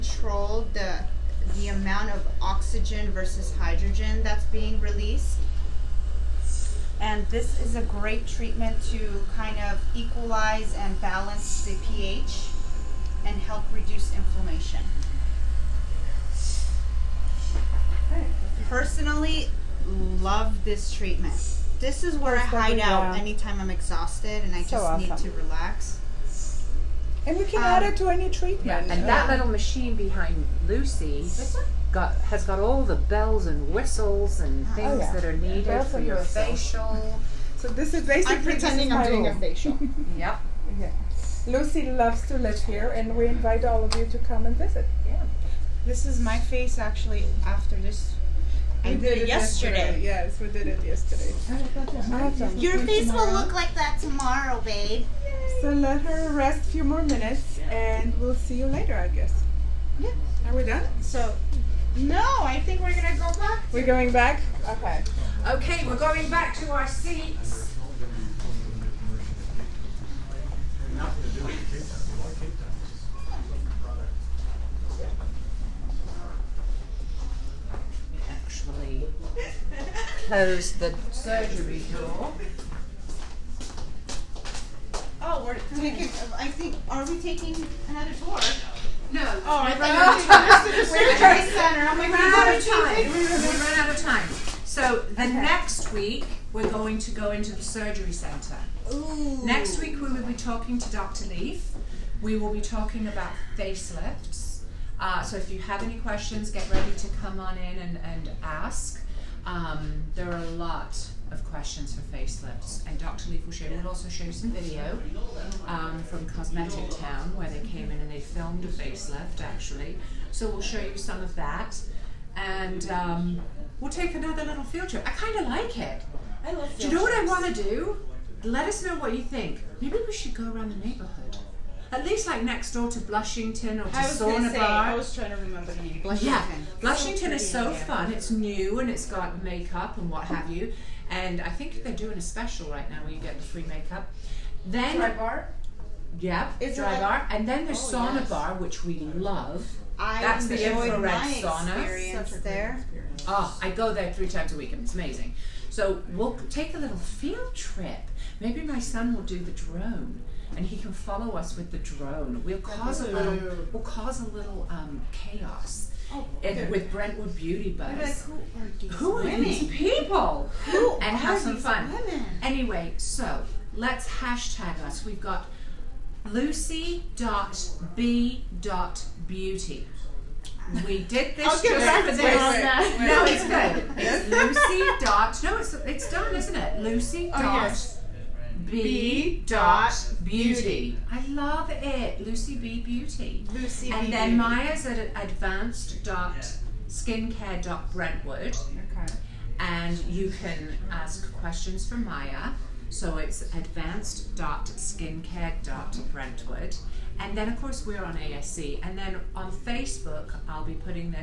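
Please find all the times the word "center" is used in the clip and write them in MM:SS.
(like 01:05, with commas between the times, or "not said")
01:31, 01:38.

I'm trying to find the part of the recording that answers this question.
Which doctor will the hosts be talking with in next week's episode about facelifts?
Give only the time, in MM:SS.
01:40.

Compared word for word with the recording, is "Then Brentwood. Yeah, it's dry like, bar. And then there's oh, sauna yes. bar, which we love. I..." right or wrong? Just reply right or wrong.
wrong.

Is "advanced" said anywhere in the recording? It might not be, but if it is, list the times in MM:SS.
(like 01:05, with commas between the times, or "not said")
03:15, 03:23.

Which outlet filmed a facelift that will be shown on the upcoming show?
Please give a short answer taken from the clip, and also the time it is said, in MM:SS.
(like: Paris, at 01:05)
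Cosmetic Town, at 01:56.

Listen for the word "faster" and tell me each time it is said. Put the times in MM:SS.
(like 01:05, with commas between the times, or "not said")
not said.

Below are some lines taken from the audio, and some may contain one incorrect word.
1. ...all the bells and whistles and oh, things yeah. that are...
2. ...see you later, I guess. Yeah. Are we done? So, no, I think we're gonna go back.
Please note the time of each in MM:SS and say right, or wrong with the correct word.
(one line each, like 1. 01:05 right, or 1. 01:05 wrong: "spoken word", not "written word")
1. 00:32 right
2. 00:58 right.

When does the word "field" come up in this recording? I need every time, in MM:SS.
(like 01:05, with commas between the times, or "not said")
02:04, 02:36.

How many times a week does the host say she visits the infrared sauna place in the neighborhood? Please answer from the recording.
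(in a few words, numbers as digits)
3.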